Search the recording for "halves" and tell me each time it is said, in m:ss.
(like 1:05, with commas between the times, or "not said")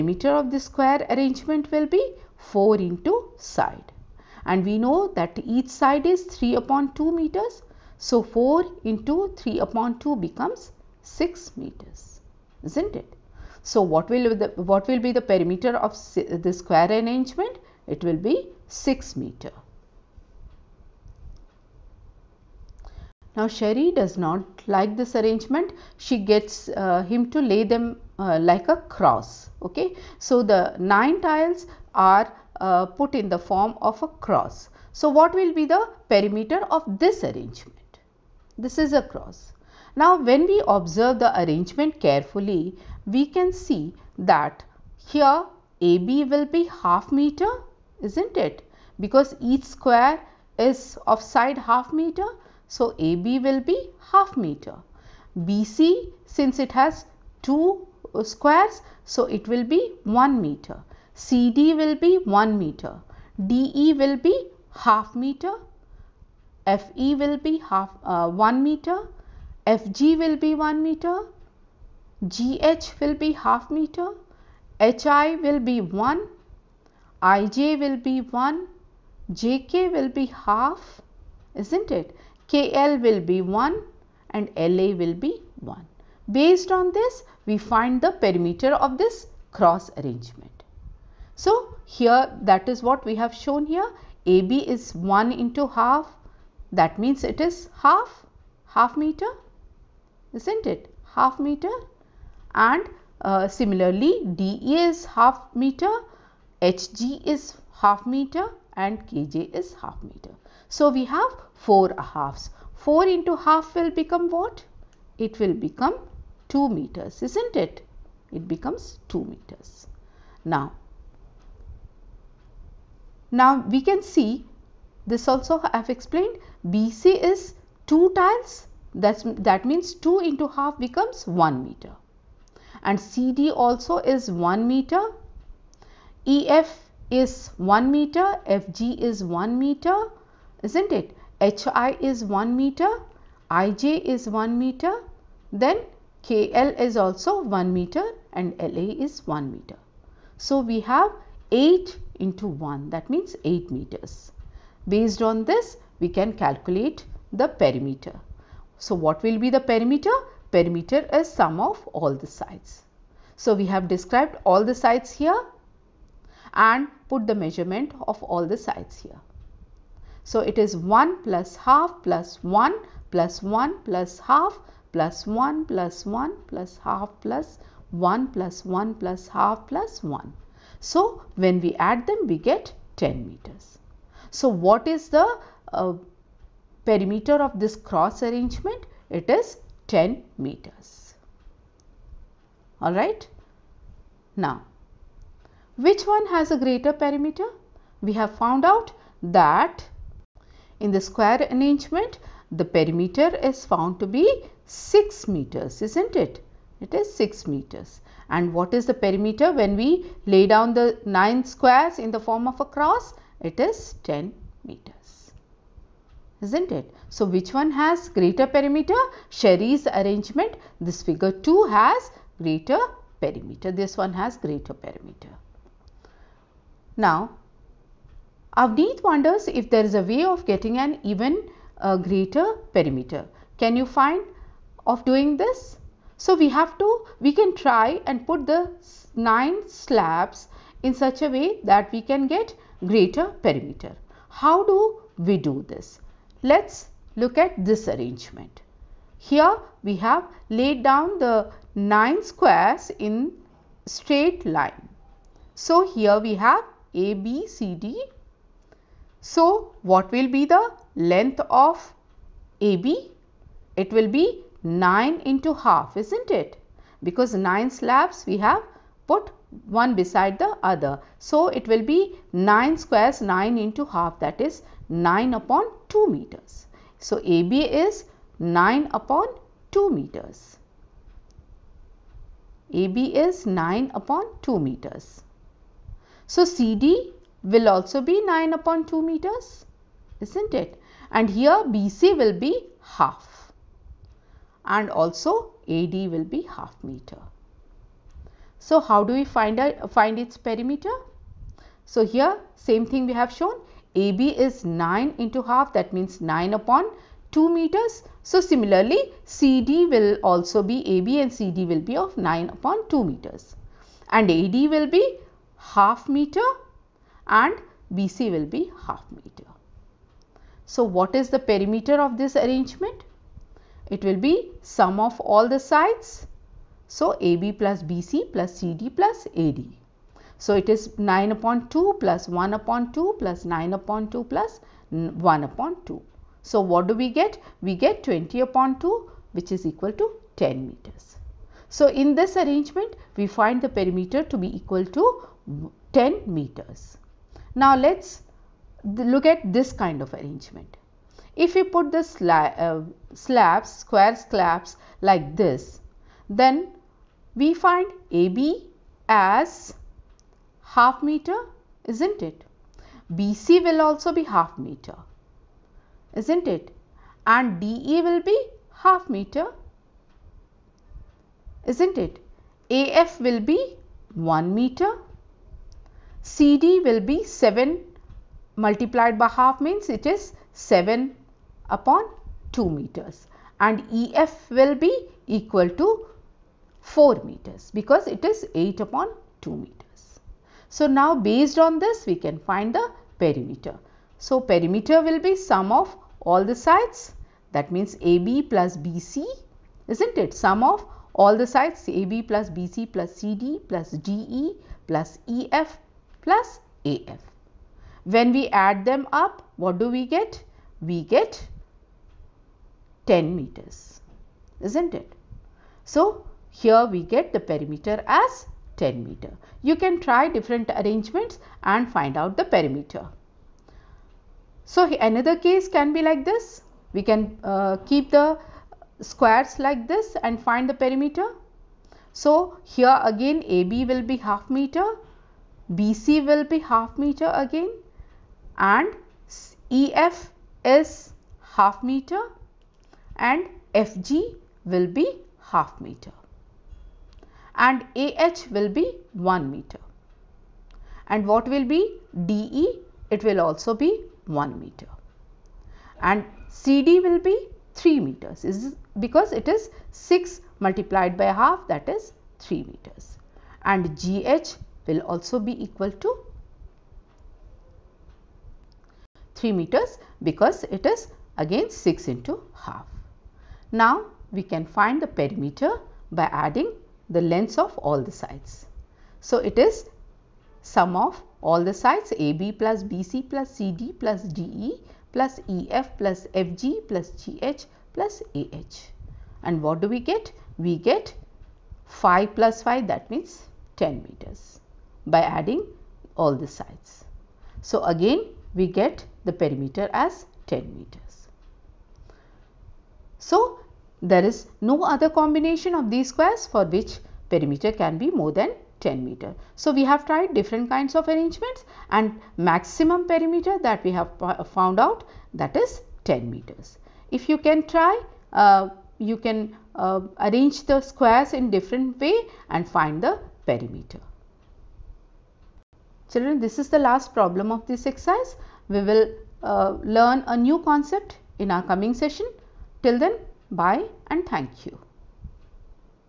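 1:51.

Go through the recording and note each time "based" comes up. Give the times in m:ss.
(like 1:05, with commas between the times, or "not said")
1:26, 2:34, 6:31.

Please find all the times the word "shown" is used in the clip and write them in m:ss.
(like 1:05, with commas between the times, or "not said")
1:33, 5:03.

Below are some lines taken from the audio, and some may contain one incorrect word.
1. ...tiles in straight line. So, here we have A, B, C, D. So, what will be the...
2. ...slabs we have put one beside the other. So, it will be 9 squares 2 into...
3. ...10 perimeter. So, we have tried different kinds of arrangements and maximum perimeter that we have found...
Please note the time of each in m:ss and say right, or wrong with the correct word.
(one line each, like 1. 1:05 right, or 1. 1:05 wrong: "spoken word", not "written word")
1. 4:12 wrong: "squares", not "tiles"
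2. 4:27 wrong: "9", not "2"
3. 8:28 wrong: "meter", not "perimeter".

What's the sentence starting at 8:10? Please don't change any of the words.
We get 5 plus 5 that means 10 meters by adding all the sides.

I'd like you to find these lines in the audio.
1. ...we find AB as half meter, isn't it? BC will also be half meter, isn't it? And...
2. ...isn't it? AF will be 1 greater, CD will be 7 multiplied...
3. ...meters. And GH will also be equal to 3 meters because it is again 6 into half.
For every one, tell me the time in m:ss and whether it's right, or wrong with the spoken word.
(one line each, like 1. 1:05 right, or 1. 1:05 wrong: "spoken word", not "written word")
1. 5:57 right
2. 6:11 wrong: "meter", not "greater"
3. 7:42 right.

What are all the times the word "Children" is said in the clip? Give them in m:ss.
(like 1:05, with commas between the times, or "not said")
8:46.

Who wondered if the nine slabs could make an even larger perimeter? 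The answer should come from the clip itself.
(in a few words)
Avneet.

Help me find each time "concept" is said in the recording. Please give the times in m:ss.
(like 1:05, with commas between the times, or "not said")
8:50.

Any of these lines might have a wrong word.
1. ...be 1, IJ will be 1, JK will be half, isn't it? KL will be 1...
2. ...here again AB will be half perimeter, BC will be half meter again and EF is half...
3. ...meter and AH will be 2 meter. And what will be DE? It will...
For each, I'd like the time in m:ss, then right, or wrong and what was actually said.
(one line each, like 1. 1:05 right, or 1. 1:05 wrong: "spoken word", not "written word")
1. 1:15 right
2. 7:12 wrong: "meter", not "perimeter"
3. 7:25 wrong: "1", not "2".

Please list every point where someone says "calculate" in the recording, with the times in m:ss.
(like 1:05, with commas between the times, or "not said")
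2:36.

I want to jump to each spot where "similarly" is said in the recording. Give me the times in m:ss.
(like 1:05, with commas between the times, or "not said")
1:43, 5:08.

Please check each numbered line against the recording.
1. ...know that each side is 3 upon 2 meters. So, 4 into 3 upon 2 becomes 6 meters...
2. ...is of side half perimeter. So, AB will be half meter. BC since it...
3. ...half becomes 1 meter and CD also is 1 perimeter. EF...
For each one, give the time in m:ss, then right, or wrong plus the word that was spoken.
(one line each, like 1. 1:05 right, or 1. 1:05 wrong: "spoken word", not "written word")
1. 0:04 right
2. 0:50 wrong: "meter", not "perimeter"
3. 2:10 wrong: "meter", not "perimeter".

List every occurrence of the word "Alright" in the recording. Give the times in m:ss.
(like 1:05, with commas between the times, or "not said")
3:12.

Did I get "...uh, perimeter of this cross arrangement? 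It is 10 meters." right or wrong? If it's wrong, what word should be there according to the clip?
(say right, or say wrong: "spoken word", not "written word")
right.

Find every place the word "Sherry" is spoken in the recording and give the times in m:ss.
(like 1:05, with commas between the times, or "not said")
0:23, 3:39.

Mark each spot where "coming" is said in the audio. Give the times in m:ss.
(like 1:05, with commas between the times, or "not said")
8:51.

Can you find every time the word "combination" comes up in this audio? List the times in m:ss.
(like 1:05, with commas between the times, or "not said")
8:25.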